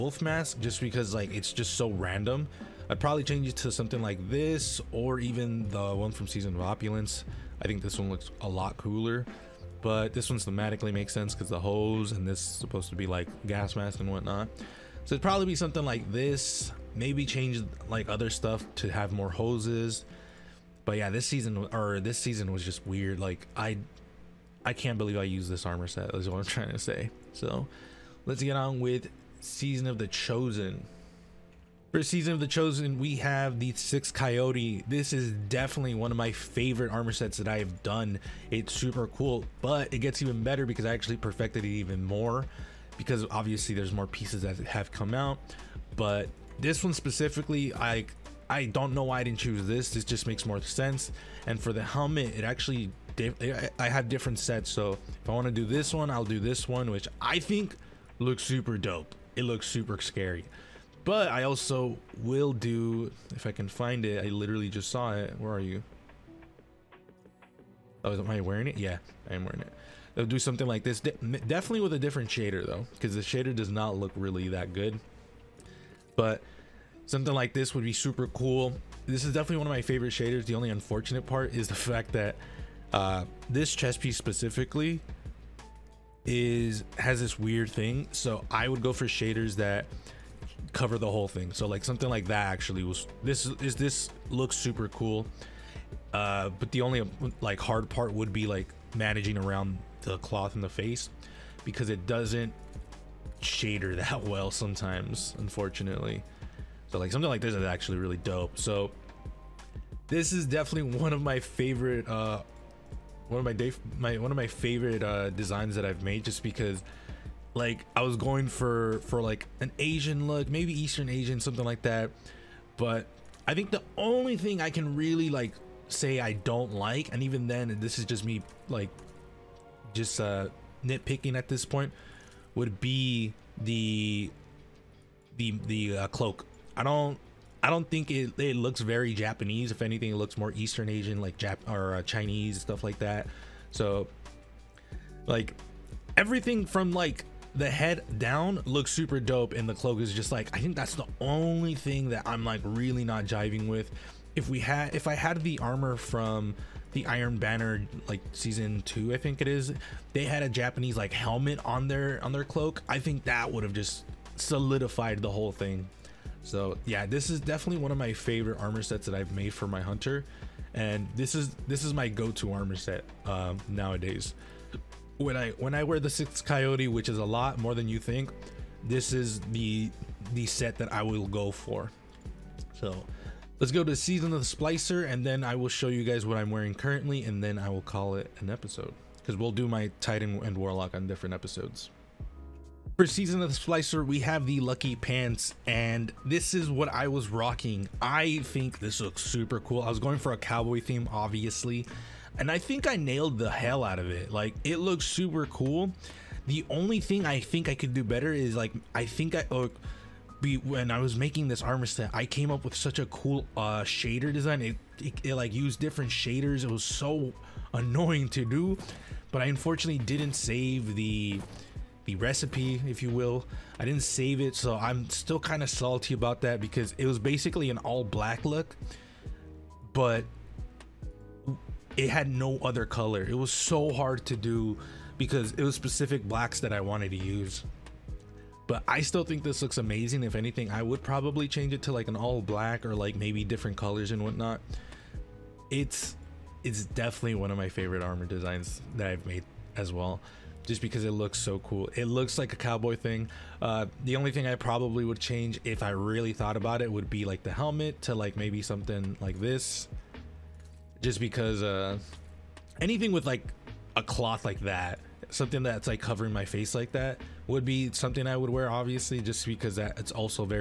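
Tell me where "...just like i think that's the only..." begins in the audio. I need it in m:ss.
2:30.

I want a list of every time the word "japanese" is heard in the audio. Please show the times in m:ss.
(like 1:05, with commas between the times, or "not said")
2:19, 2:40.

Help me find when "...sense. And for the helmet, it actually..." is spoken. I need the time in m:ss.
0:50.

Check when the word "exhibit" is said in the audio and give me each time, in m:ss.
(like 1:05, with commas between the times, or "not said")
not said.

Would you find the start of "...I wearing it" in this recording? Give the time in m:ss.
1:08.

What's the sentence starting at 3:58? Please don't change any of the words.
But I still think this looks amazing.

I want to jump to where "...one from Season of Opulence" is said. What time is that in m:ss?
0:05.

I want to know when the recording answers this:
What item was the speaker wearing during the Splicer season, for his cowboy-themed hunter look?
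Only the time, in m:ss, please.
3:14.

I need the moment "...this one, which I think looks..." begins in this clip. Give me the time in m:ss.
0:56.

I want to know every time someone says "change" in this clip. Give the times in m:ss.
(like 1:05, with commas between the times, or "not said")
0:03, 0:17, 4:01, 4:15.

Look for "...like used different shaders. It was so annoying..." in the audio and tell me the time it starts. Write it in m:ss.
3:35.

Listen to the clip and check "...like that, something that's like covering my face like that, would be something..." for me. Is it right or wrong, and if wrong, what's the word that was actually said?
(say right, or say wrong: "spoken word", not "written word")
right.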